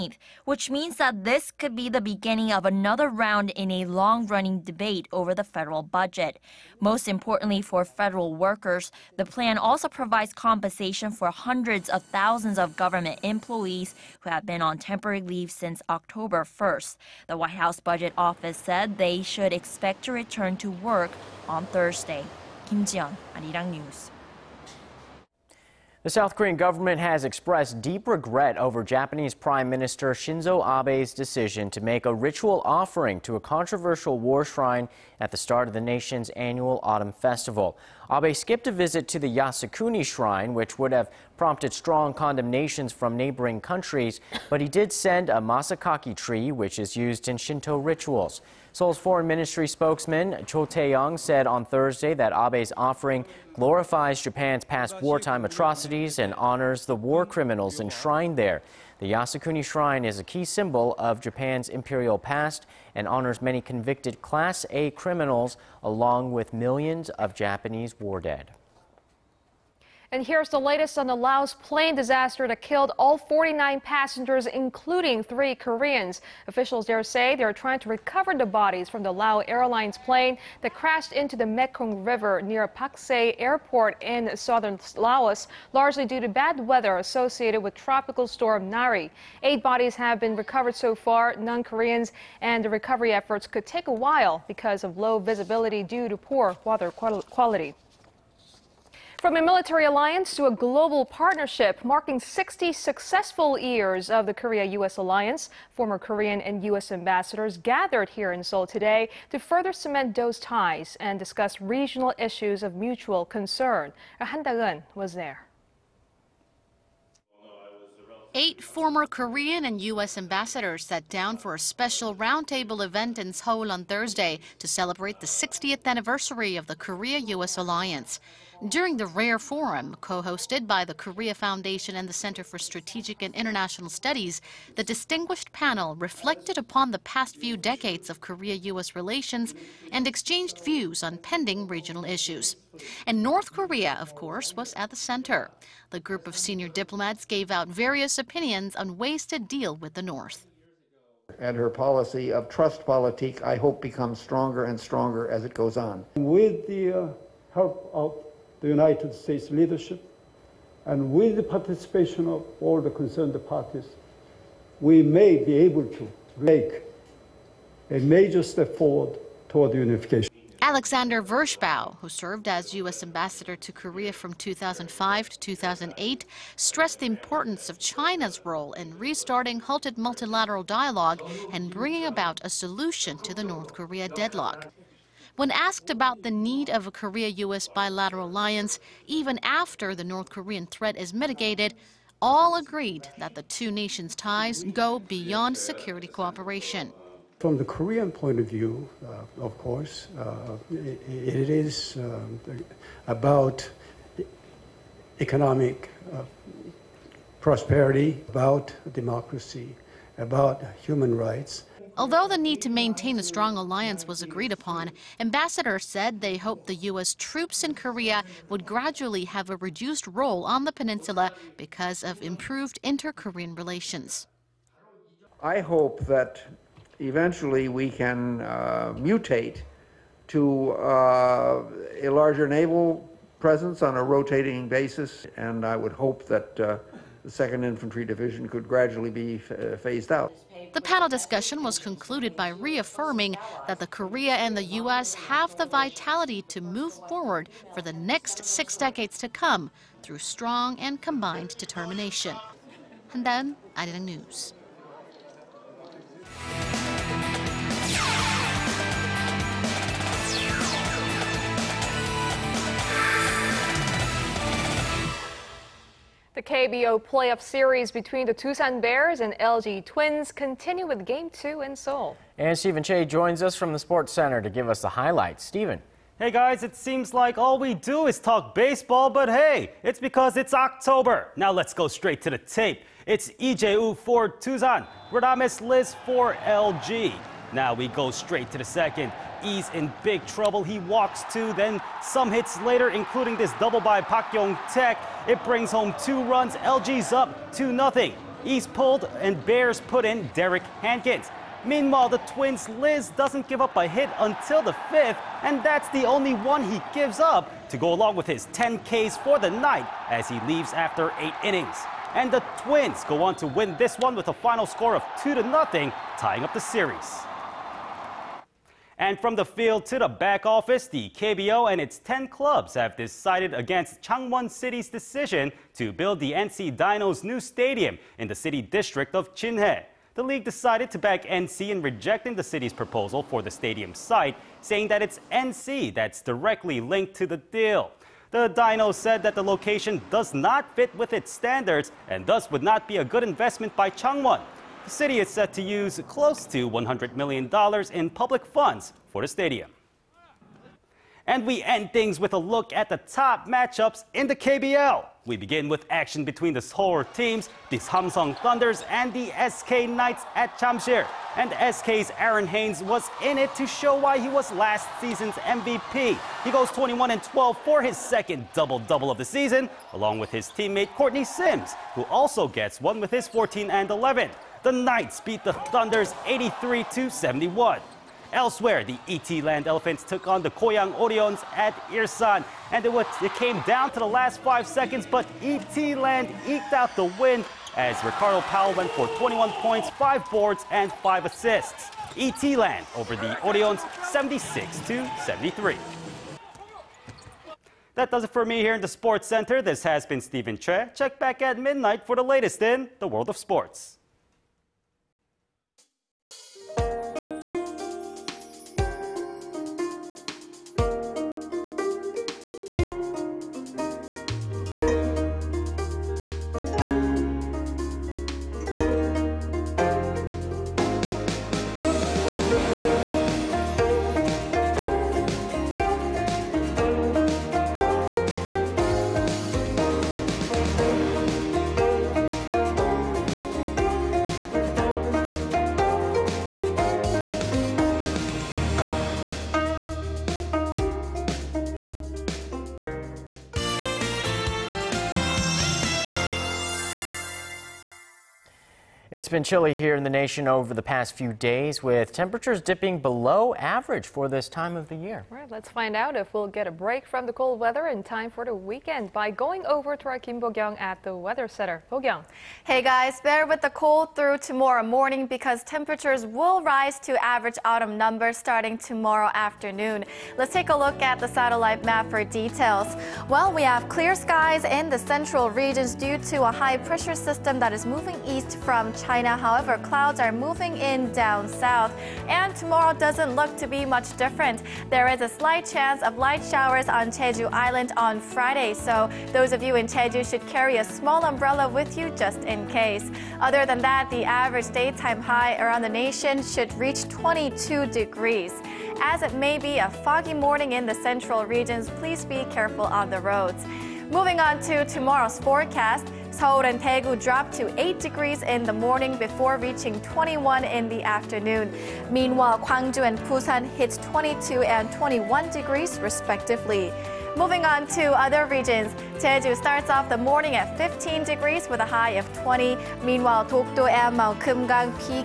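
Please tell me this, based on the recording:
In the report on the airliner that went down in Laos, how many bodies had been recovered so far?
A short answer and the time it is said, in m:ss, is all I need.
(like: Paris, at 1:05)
8, at 1:29.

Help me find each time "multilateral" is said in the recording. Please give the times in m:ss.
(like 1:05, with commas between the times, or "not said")
2:59.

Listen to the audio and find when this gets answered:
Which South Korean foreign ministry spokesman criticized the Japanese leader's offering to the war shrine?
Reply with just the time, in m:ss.
0:50.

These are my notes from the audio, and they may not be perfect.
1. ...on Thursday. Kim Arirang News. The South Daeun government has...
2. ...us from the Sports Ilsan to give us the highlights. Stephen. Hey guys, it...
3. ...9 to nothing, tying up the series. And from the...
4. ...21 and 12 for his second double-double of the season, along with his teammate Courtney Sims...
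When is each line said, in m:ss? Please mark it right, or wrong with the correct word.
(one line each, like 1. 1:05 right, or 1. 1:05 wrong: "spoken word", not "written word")
1. 0:21 wrong: "Korean", not "Daeun"
2. 4:33 wrong: "Center", not "Ilsan"
3. 5:15 wrong: "2", not "9"
4. 6:06 right.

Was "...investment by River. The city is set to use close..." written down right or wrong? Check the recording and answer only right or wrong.
wrong.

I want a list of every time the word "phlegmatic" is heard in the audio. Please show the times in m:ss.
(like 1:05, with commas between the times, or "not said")
not said.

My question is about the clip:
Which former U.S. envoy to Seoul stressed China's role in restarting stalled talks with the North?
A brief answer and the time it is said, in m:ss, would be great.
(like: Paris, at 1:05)
Alexander Vershbow, at 2:50.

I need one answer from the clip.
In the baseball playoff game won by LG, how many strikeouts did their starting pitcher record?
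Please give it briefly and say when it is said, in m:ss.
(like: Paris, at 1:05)
10, at 5:08.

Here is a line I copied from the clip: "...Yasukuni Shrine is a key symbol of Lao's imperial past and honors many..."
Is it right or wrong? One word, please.
wrong.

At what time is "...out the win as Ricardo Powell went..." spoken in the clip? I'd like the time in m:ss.
6:26.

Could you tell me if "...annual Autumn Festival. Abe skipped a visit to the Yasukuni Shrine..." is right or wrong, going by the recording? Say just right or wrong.
right.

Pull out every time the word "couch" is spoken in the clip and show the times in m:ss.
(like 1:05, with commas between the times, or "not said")
not said.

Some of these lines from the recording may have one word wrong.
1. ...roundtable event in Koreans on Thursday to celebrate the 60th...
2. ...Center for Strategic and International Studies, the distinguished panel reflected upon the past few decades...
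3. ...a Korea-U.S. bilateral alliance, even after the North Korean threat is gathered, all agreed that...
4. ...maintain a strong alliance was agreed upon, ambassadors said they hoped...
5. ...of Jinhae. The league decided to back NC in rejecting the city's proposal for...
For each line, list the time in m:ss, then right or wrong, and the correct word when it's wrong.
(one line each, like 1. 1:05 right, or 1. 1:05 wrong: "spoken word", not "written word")
1. 2:02 wrong: "Seoul", not "Koreans"
2. 2:12 right
3. 3:06 wrong: "mitigated", not "gathered"
4. 3:32 right
5. 5:29 right.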